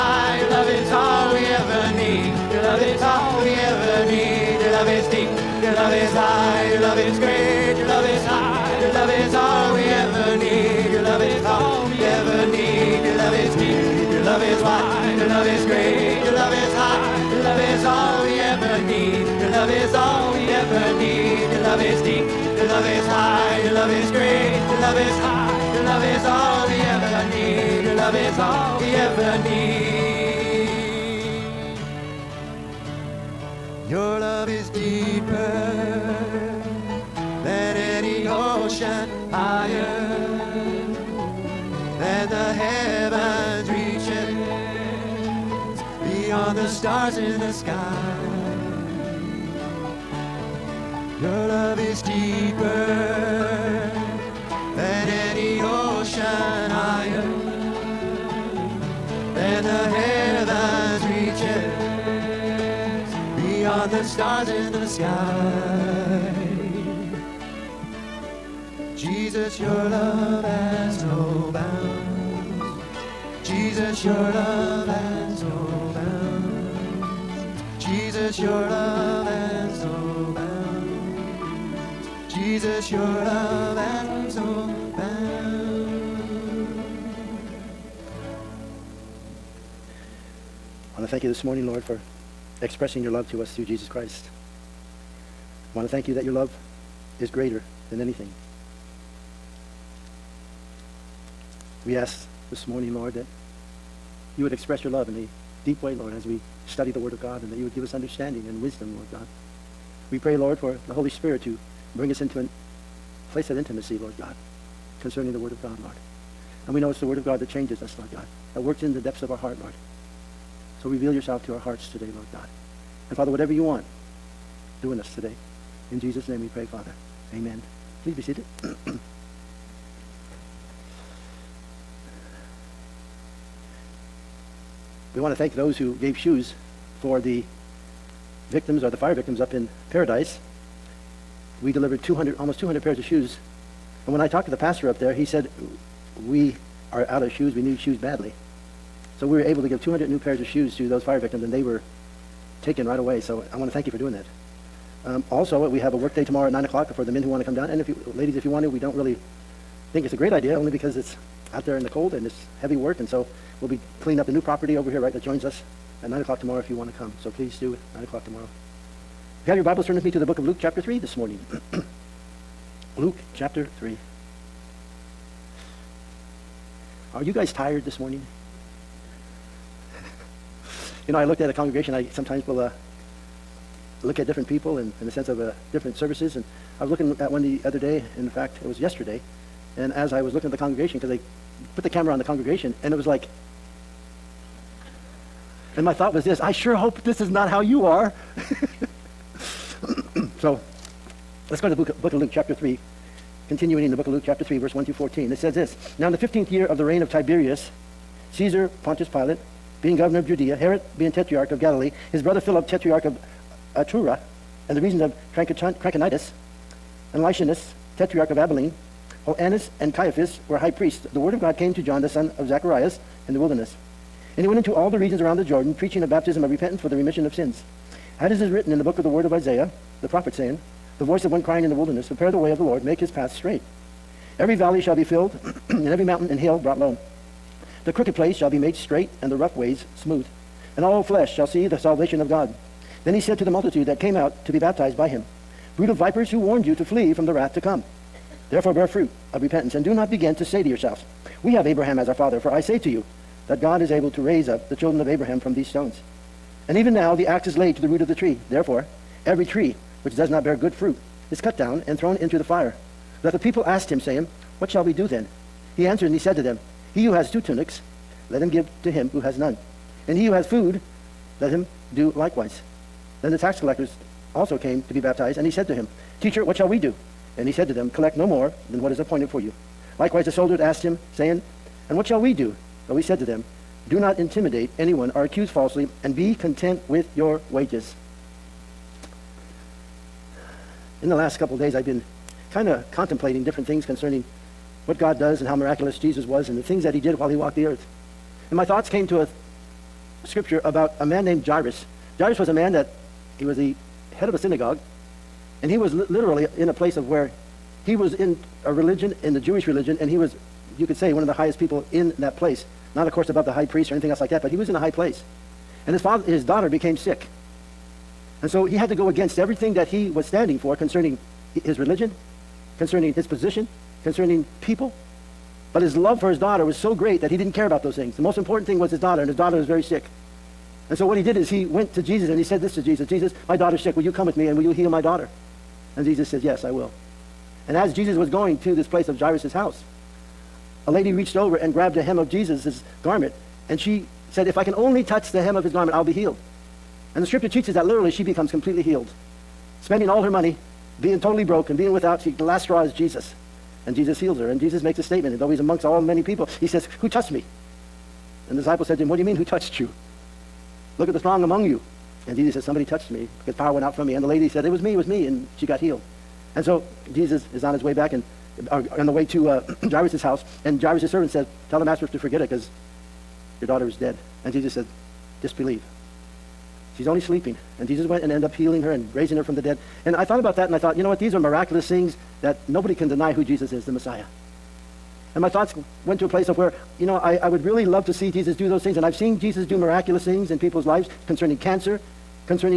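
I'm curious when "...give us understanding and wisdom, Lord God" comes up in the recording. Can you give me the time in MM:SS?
01:47.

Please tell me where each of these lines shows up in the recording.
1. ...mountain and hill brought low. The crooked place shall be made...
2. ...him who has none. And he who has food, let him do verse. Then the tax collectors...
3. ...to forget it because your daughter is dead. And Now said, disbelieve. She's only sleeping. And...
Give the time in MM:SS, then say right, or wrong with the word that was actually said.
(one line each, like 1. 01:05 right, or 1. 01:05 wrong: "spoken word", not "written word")
1. 03:56 right
2. 04:28 wrong: "likewise", not "verse"
3. 06:12 wrong: "Jesus", not "Now".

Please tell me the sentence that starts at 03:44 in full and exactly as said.
And he went into all the regions around the Jordan, preaching a baptism of repentance for the remission of sins.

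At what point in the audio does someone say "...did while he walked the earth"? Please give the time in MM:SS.
04:56.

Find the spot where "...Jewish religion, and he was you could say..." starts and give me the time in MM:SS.
05:09.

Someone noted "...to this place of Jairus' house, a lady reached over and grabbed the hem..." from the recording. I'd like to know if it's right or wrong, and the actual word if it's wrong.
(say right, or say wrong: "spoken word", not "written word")
right.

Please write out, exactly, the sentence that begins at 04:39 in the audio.
Likewise the soldiers asked him, saying, And what shall we do?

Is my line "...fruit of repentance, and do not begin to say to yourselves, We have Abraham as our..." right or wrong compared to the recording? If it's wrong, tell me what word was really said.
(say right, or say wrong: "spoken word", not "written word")
right.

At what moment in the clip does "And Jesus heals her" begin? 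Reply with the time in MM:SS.
05:53.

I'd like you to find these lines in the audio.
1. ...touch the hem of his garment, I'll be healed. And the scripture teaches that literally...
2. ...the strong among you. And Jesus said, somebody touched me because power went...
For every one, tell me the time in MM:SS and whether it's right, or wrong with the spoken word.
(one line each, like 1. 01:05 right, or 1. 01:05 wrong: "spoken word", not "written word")
1. 05:45 right
2. 06:01 right.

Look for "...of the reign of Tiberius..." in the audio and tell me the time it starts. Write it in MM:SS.
03:26.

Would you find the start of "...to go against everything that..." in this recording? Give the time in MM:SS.
05:18.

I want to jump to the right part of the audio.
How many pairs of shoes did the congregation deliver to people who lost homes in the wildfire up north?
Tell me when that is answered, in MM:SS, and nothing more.
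02:22.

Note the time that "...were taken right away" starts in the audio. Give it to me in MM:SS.
02:31.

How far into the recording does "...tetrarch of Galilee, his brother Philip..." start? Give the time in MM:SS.
03:31.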